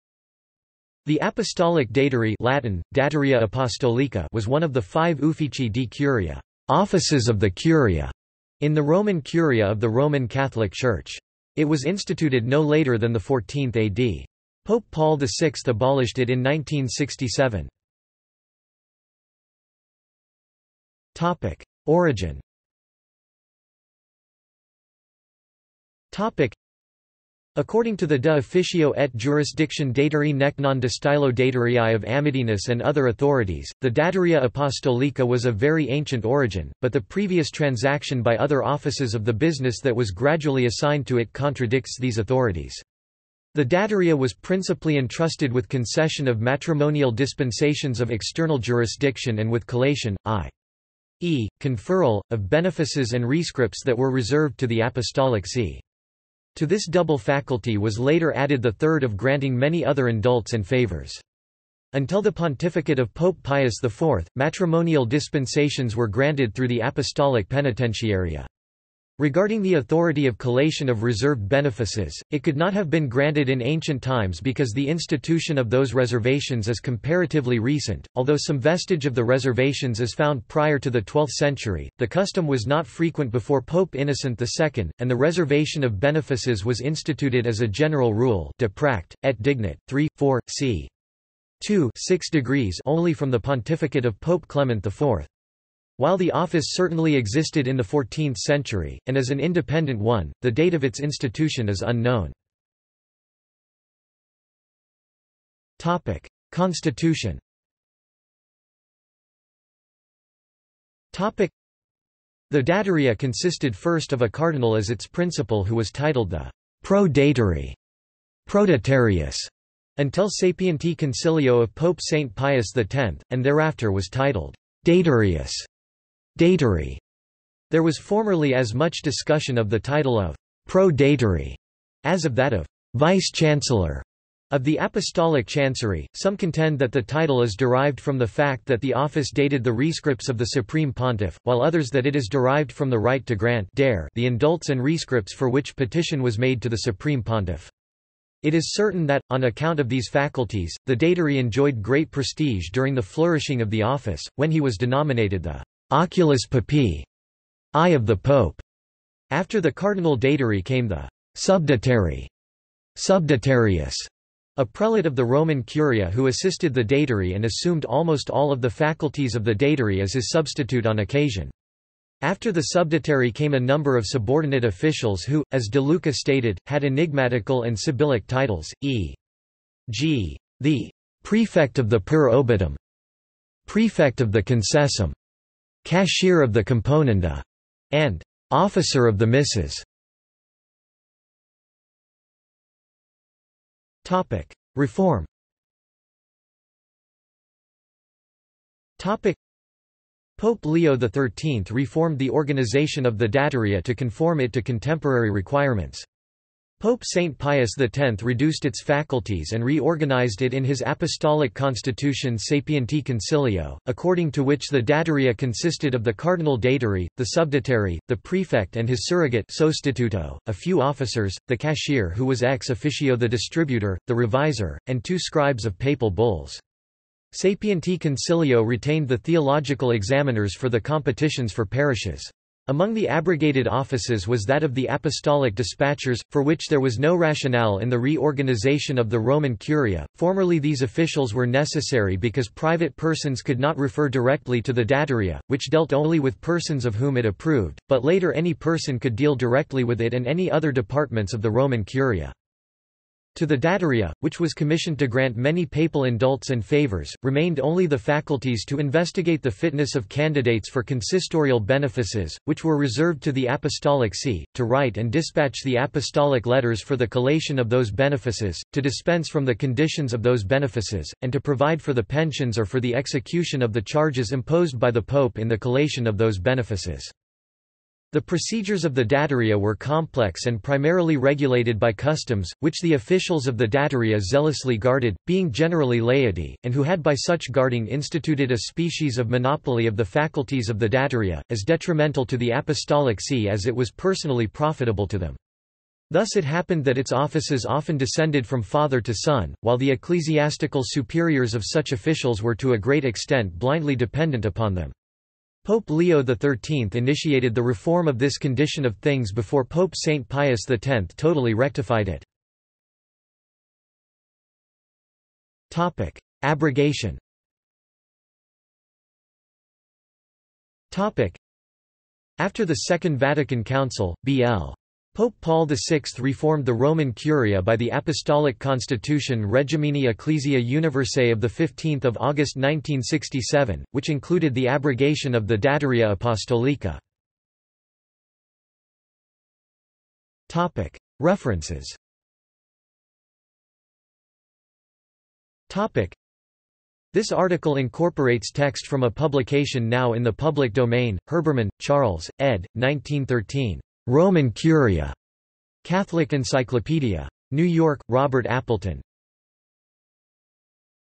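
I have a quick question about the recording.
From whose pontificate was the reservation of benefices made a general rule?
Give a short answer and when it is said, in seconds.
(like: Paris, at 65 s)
Pope Clement IV, at 94 s.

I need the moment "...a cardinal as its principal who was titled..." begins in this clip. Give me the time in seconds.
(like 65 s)
114 s.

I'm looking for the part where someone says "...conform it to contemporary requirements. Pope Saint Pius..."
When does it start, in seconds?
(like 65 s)
203 s.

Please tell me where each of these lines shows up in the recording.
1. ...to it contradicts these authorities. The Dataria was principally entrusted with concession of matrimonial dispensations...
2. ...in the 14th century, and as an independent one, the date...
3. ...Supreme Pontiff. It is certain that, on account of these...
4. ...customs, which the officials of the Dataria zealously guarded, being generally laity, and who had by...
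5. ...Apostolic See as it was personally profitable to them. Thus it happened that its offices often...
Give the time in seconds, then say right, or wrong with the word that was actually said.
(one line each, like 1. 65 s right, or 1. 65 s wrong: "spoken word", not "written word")
1. 41 s right
2. 97 s right
3. 146 s right
4. 281 s right
5. 292 s right.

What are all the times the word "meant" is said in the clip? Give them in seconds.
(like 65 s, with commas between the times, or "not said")
not said.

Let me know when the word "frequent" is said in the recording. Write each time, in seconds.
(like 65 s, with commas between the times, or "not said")
82 s.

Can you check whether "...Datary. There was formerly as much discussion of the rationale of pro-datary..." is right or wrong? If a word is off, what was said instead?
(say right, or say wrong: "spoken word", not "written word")
wrong: "title", not "rationale".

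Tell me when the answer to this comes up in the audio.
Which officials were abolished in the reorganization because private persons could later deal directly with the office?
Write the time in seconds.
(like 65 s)
234 s.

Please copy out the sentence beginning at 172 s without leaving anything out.
After the subdatary came a number of subordinate officials who, as De Luca stated, had enigmatical and sibyllic titles, e.g.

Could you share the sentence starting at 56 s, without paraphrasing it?
To this double faculty was later added the third of granting many other indults and favors.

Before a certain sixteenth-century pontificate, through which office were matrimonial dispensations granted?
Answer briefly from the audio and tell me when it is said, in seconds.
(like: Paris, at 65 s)
Apostolic Penitentiaria, at 66 s.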